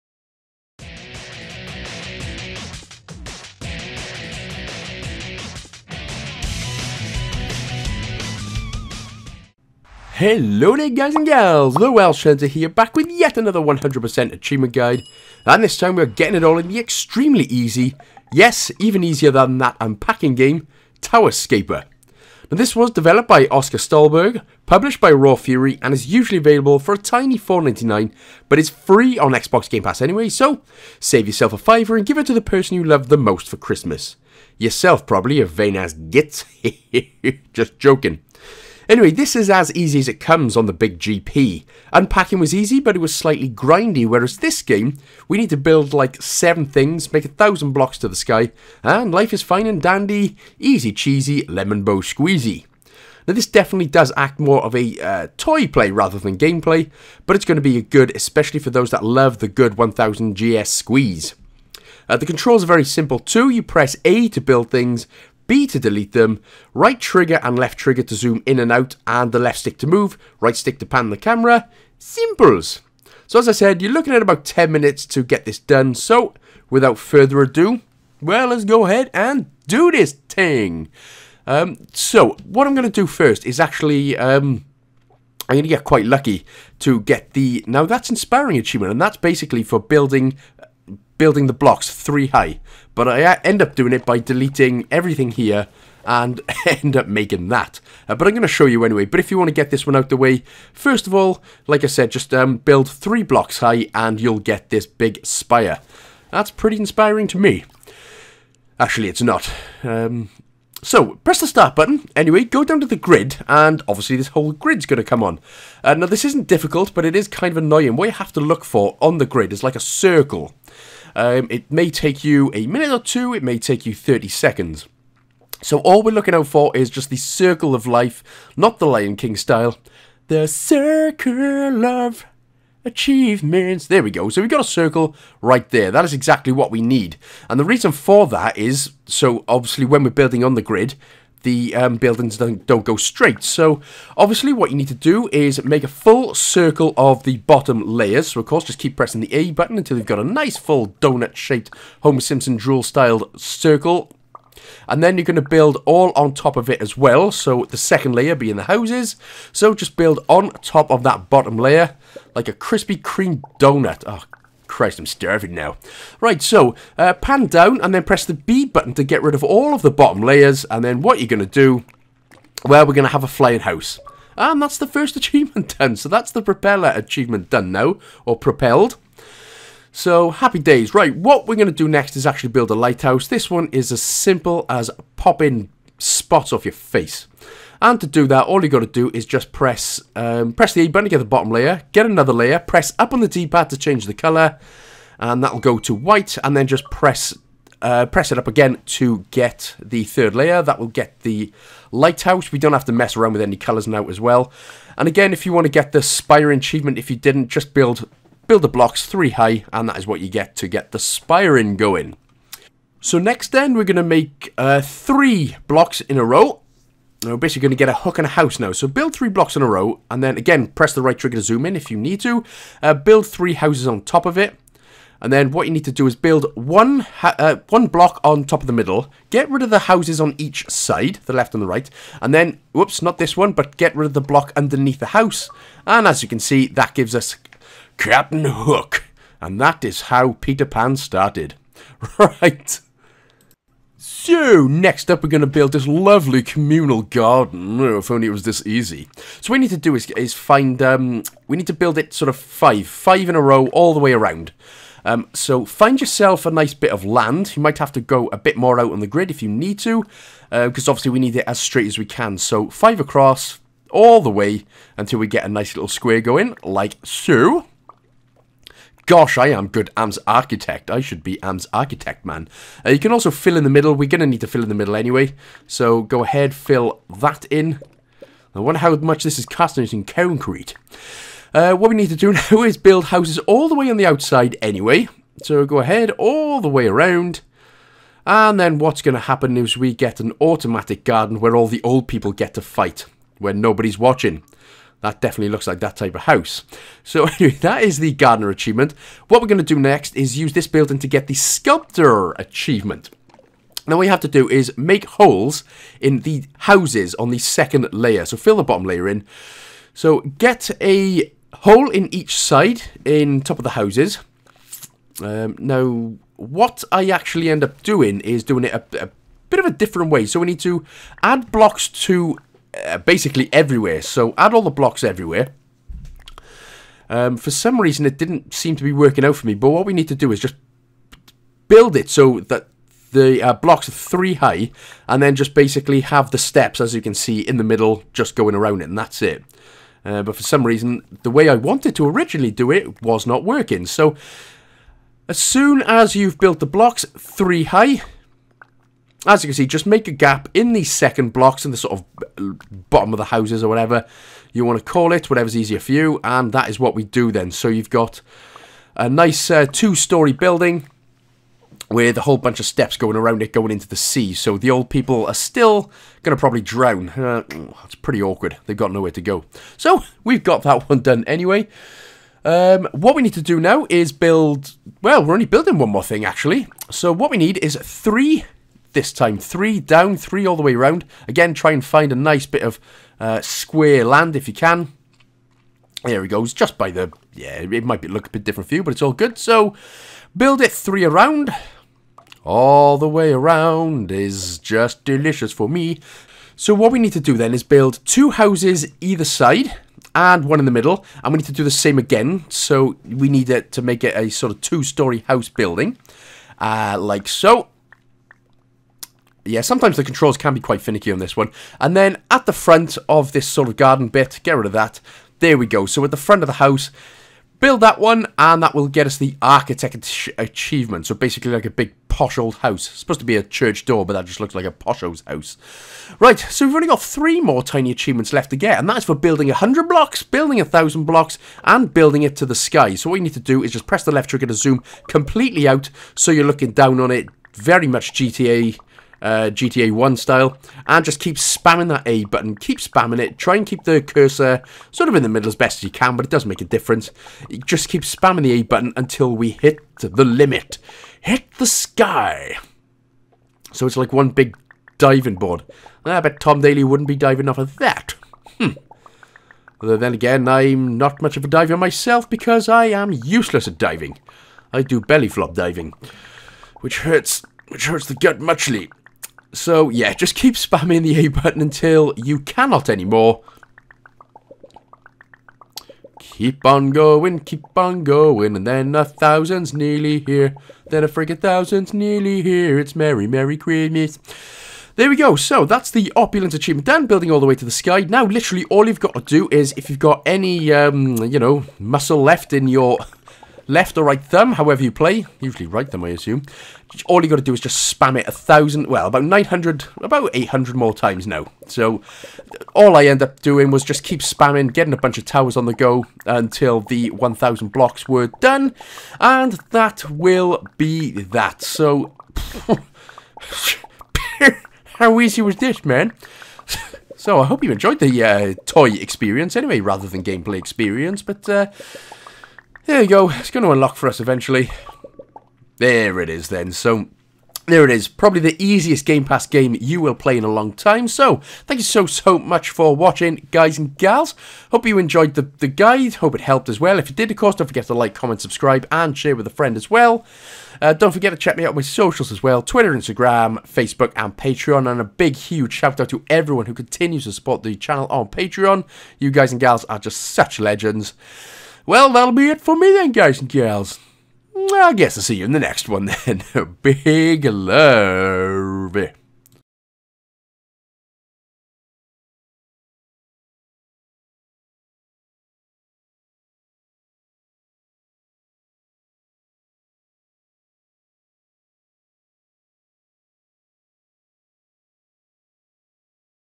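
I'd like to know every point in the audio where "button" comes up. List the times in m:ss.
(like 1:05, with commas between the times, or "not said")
1:51, 2:29, 2:48, 3:10, 7:22, 7:28, 7:51.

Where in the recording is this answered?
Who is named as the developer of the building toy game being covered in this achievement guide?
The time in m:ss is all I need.
0:23.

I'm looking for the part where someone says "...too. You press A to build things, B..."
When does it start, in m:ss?
1:03.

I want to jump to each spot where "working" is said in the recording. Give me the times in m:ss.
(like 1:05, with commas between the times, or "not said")
5:28, 5:43.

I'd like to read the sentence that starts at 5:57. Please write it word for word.
So you've got a nice uh, two-story building with a whole bunch of steps going around it going into the sea.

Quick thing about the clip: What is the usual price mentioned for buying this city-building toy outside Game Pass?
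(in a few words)
$4.99.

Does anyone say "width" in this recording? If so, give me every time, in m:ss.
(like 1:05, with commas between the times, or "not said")
not said.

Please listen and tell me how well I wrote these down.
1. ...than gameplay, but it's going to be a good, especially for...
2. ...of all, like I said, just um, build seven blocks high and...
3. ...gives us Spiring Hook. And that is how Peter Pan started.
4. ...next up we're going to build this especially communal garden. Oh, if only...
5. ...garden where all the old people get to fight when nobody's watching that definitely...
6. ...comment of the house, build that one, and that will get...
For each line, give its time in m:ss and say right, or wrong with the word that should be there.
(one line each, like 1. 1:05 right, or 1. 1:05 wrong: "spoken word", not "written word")
1. 0:56 right
2. 1:41 wrong: "three", not "seven"
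3. 3:56 wrong: "Captain", not "Spiring"
4. 4:04 wrong: "lovely", not "especially"
5. 4:51 right
6. 6:56 wrong: "front", not "comment".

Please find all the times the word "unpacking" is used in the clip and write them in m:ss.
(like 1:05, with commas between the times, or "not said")
0:19, 0:41.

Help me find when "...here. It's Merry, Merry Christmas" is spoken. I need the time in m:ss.
8:02.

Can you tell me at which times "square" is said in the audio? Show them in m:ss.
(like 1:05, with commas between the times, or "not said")
4:25, 6:23.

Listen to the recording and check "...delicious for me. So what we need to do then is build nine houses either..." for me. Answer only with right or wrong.
wrong.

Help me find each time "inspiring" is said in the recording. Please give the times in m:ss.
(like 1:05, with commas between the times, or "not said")
1:28, 1:46.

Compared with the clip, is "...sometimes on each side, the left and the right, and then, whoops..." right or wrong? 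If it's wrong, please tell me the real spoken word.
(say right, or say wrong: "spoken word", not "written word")
wrong: "houses", not "sometimes".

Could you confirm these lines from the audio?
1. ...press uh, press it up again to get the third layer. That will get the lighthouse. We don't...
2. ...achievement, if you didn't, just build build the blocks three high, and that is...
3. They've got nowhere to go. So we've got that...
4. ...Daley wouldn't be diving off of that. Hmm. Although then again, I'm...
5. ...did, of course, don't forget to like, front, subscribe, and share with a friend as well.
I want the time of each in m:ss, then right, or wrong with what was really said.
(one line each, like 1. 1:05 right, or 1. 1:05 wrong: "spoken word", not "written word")
1. 3:16 right
2. 3:26 right
3. 6:08 right
4. 7:36 right
5. 8:57 wrong: "comment", not "front".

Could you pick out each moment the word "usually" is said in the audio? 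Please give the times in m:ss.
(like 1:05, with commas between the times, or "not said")
0:26, 8:15.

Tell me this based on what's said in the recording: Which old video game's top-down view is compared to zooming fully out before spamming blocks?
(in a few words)
GTA 1.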